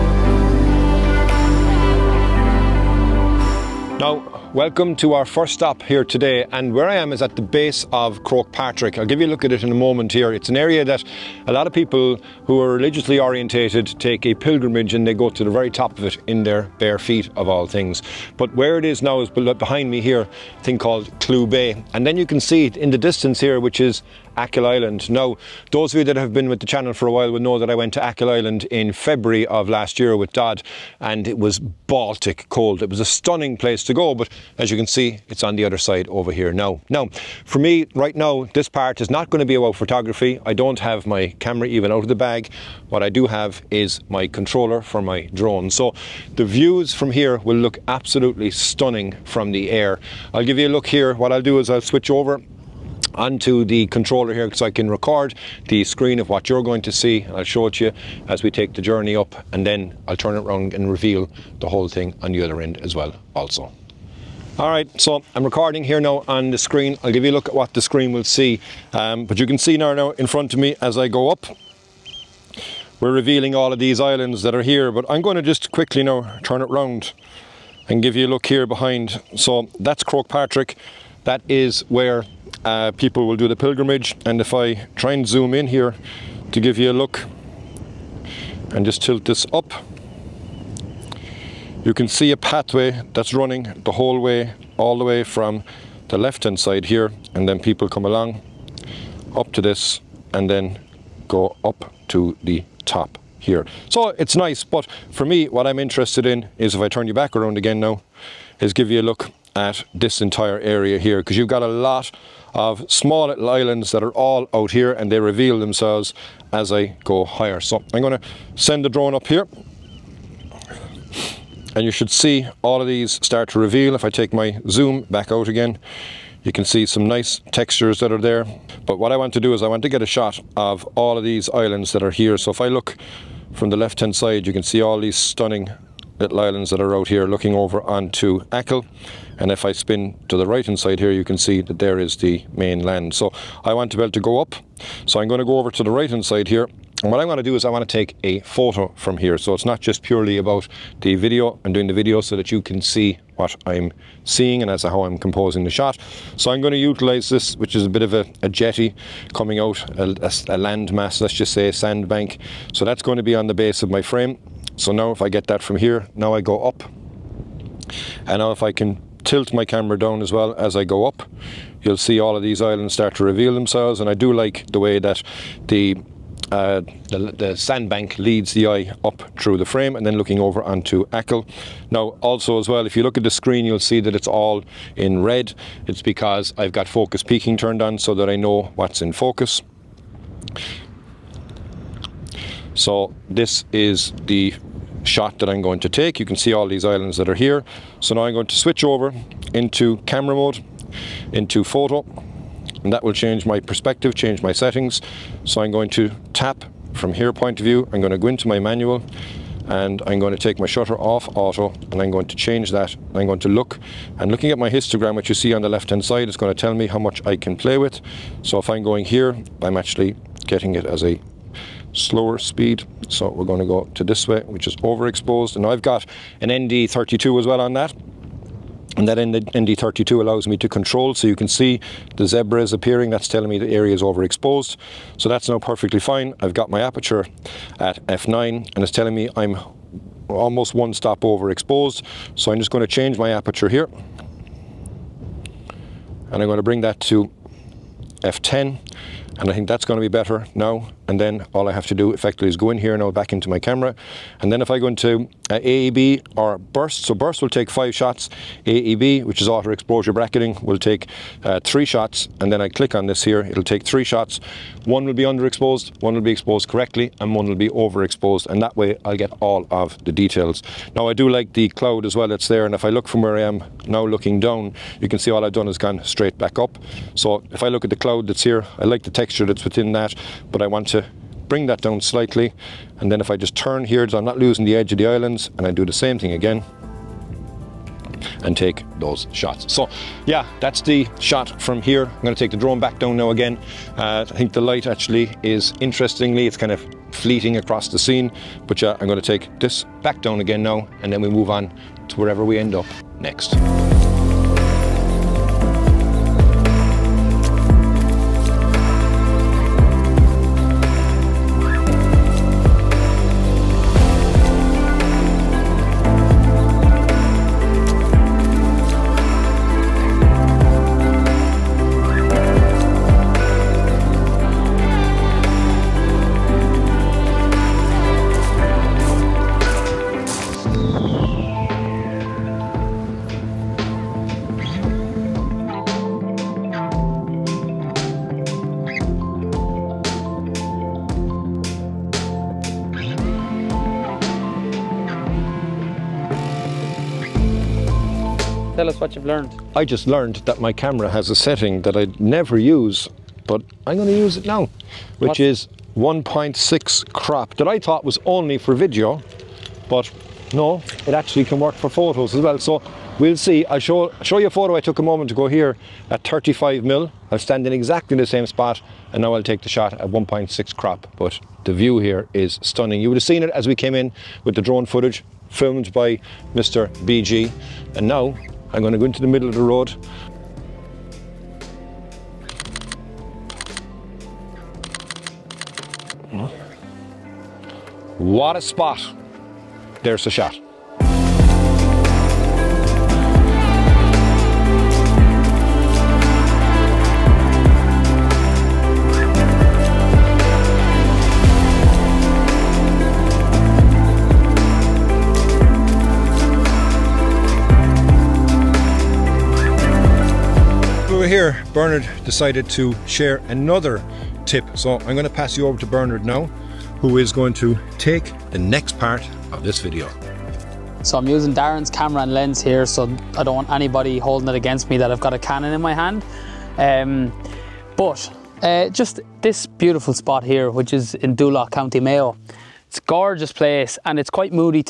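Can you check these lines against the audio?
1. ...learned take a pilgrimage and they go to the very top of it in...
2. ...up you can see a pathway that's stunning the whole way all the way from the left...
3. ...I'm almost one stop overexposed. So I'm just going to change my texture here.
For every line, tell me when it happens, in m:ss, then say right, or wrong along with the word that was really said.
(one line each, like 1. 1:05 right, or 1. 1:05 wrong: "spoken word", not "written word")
1. 0:13 wrong: "orientated", not "learned"
2. 1:29 wrong: "running", not "stunning"
3. 3:59 wrong: "aperture", not "texture".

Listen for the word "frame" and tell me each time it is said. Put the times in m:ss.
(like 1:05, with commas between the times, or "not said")
2:44, 2:59.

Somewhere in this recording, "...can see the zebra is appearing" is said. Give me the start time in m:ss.
3:51.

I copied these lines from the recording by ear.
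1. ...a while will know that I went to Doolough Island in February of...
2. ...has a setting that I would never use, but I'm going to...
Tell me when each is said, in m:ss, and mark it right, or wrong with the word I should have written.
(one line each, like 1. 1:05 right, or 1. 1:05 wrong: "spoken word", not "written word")
1. 0:27 wrong: "Achill", not "Doolough"
2. 5:51 right.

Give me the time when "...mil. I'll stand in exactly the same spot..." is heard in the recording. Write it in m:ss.
6:06.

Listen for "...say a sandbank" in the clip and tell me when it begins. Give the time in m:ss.
2:41.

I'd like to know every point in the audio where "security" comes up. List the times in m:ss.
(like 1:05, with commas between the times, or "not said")
not said.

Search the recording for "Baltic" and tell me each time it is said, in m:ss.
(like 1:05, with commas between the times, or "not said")
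0:31.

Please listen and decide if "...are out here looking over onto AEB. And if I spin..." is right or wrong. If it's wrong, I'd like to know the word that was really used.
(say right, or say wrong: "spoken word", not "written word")
wrong: "Achill", not "AEB".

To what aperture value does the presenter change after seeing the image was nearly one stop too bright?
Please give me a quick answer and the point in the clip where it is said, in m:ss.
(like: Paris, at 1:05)
f10, at 4:08.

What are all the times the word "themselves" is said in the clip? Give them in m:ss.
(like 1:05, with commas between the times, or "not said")
1:55, 2:53.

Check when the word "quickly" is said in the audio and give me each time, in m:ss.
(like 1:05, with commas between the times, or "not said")
1:15.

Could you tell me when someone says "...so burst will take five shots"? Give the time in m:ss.
4:17.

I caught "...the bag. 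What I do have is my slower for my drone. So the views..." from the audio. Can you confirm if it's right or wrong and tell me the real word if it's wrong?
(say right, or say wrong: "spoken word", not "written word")
wrong: "controller", not "slower".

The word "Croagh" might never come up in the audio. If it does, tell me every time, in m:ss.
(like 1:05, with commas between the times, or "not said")
0:08, 1:20.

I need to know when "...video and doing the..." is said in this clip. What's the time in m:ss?
2:31.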